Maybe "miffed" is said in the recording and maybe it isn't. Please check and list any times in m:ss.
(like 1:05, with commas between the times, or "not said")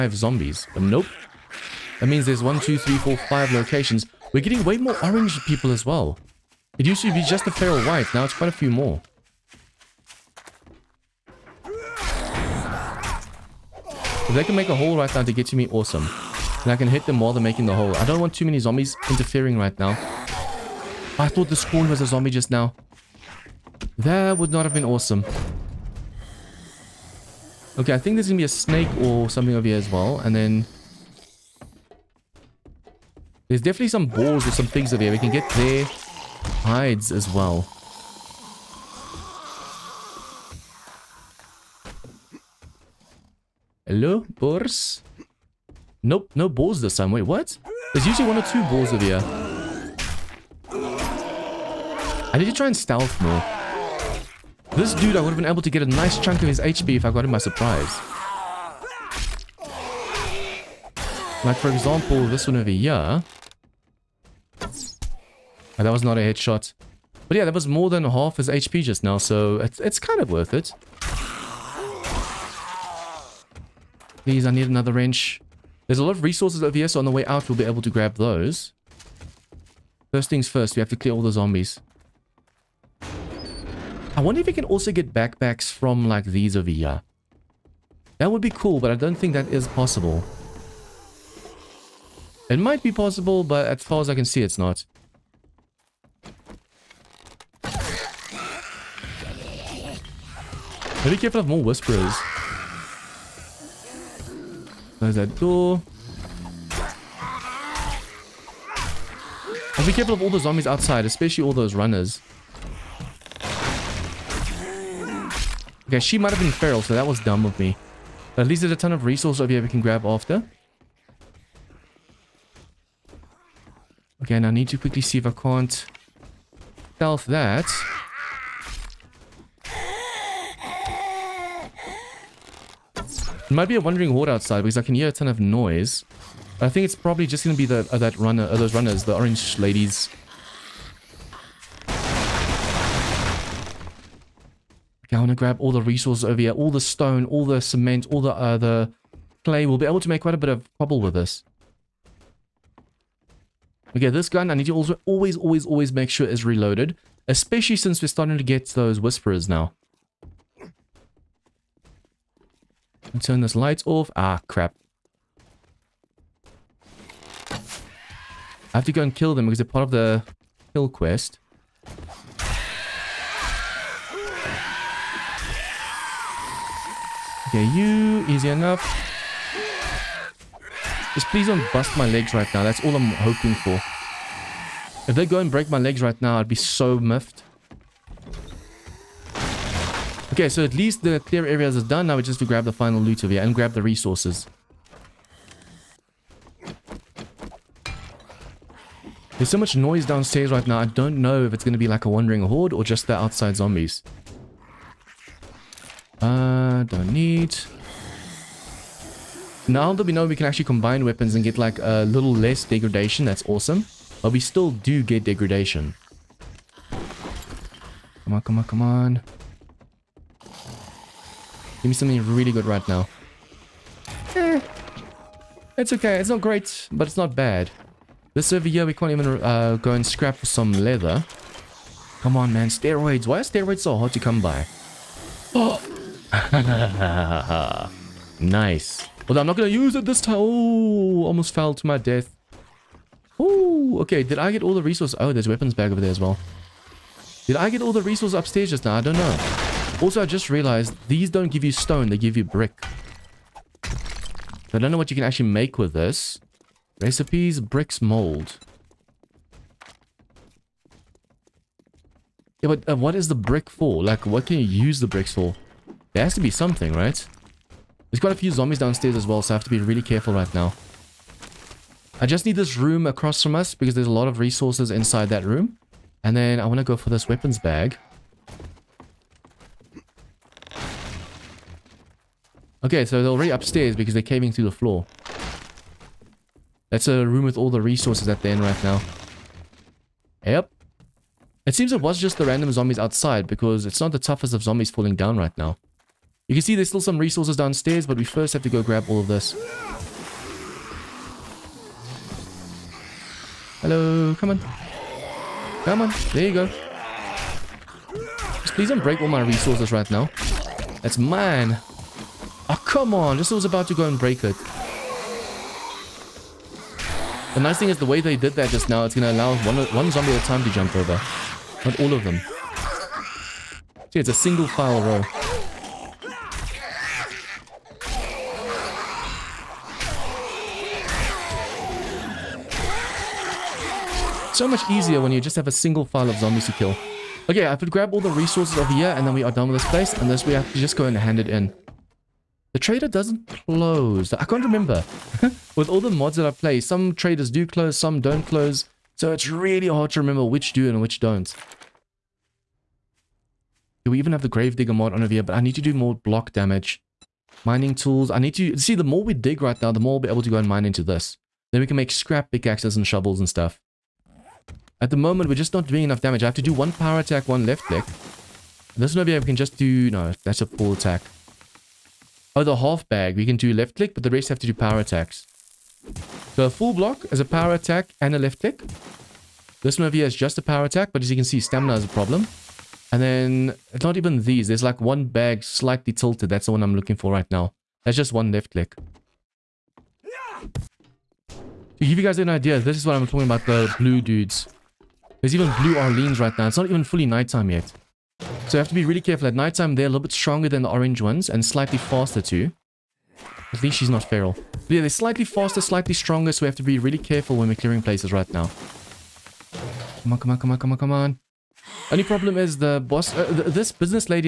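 3:06.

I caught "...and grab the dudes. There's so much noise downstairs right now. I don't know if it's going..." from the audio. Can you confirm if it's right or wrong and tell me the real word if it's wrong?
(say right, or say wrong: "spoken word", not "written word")
wrong: "resources", not "dudes".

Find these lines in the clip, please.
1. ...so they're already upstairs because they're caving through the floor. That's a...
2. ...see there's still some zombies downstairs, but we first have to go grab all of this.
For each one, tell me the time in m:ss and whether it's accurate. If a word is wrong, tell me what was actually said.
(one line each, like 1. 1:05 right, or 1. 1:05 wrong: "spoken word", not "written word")
1. 4:43 right
2. 4:56 wrong: "resources", not "zombies".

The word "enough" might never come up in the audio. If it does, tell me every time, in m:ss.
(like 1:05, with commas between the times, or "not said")
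2:58, 6:06.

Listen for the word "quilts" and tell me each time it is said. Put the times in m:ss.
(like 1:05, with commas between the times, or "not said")
not said.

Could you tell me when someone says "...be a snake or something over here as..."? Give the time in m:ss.
0:28.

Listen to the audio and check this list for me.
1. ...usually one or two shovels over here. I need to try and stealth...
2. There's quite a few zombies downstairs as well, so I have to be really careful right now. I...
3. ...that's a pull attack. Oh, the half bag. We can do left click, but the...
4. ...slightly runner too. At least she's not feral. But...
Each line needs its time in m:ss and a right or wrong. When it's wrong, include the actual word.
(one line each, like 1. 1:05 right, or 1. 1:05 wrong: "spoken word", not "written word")
1. 0:48 wrong: "balls", not "shovels"
2. 4:28 right
3. 6:10 right
4. 6:41 wrong: "faster", not "runner".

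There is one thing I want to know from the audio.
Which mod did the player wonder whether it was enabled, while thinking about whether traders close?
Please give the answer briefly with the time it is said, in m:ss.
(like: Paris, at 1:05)
Gravedigger, at 5:54.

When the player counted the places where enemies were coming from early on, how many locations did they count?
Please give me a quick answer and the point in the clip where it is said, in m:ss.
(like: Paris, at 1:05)
5, at 0:03.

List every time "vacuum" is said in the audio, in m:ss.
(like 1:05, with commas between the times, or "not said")
not said.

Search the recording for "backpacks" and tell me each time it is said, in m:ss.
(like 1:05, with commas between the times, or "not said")
1:25.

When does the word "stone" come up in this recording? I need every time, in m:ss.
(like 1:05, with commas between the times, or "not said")
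2:26, 4:11.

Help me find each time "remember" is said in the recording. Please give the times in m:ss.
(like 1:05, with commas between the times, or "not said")
5:44, 5:50.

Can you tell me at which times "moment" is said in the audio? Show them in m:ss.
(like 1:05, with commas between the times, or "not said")
6:05.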